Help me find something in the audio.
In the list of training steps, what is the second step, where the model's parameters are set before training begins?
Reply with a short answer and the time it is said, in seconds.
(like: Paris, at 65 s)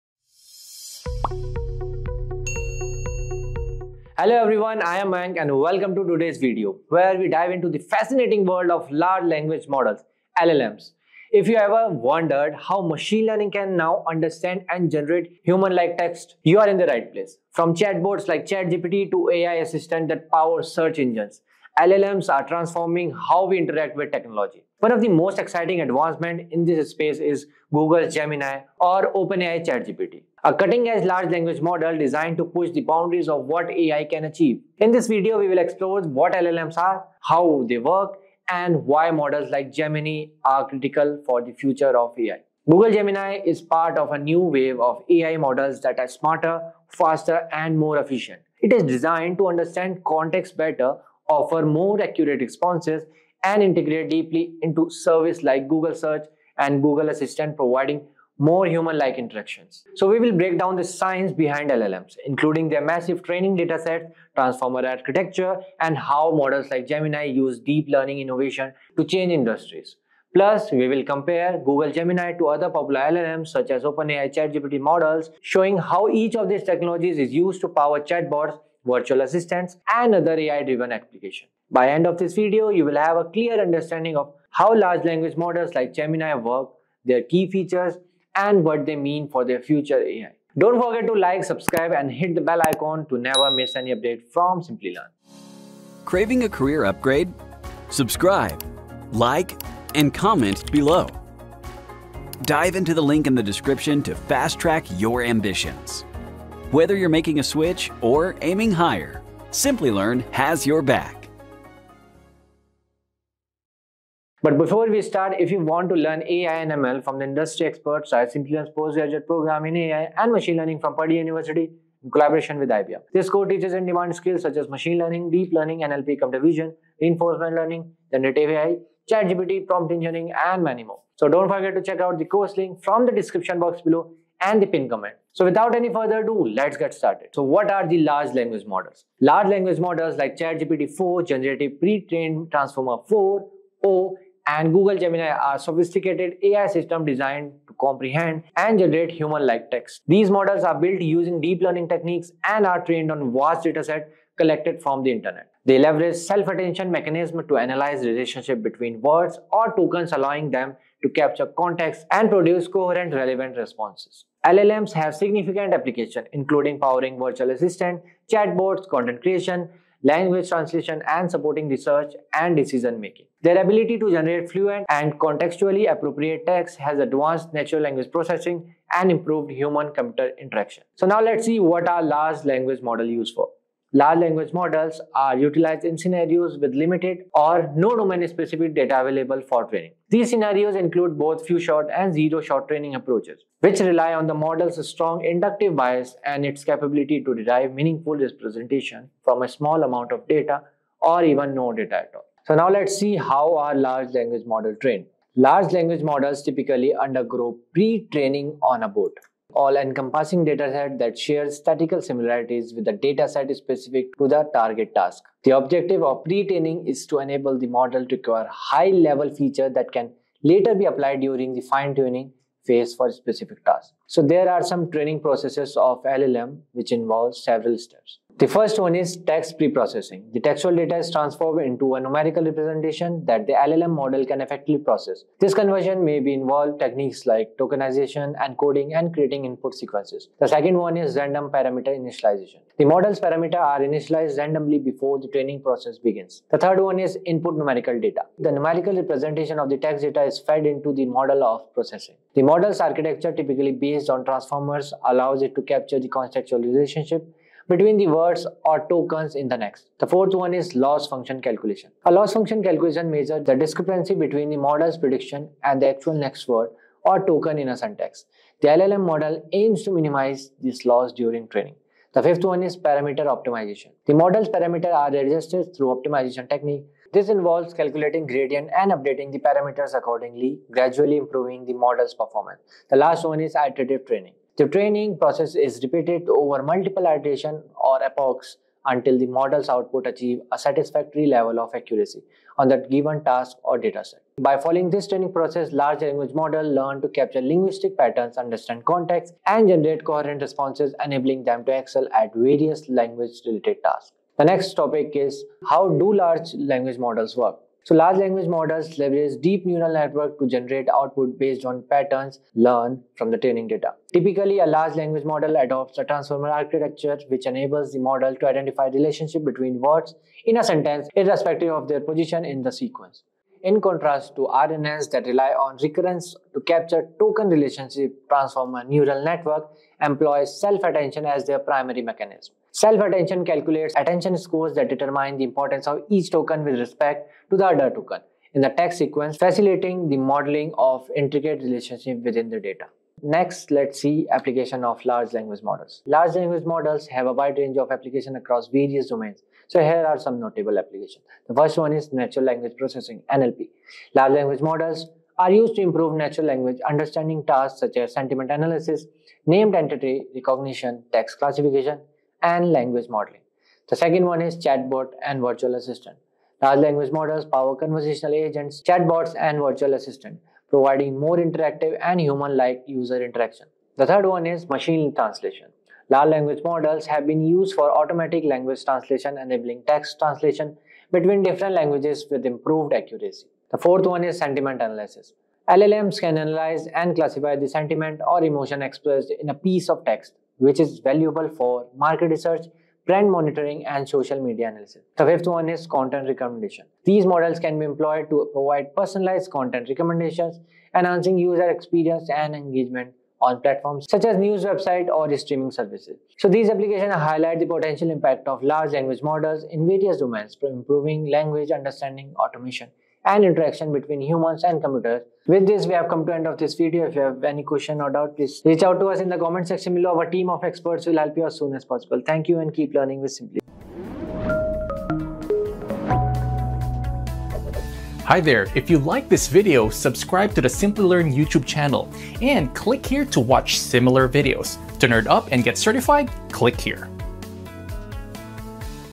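random parameter initialization, at 241 s.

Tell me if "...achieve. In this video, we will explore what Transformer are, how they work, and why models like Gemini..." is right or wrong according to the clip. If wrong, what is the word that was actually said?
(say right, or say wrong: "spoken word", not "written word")
wrong: "LLMs", not "Transformer".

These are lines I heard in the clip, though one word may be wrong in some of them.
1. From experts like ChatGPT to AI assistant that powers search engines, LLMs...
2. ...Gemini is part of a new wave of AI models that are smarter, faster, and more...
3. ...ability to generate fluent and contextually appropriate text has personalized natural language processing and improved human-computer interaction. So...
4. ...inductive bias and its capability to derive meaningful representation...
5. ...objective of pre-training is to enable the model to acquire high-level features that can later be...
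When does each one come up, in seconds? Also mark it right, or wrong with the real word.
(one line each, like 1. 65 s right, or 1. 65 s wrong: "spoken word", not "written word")
1. 17 s wrong: "chatbots", not "experts"
2. 42 s right
3. 173 s wrong: "advanced", not "personalized"
4. 195 s right
5. 215 s right.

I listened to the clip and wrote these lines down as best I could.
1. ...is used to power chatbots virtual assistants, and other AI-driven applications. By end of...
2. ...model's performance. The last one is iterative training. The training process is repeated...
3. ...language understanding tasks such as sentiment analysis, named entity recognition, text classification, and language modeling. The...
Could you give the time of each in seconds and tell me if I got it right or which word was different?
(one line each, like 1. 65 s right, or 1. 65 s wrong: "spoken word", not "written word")
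1. 77 s right
2. 281 s right
3. 356 s right.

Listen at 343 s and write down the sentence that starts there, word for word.
Next, let's see application of large language models.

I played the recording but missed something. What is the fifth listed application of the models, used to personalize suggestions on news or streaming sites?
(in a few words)
content recommendation.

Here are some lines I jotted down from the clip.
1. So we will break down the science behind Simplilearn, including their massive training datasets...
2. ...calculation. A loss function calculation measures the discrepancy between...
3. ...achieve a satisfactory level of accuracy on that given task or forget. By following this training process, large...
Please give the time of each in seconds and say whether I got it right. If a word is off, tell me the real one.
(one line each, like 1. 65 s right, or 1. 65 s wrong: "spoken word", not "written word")
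1. 59 s wrong: "LLMs", not "Simplilearn"
2. 261 s right
3. 290 s wrong: "dataset", not "forget".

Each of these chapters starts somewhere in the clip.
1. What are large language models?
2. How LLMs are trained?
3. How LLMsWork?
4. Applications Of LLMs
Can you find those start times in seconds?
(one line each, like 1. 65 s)
1. 137 s
2. 202 s
3. 305 s
4. 348 s.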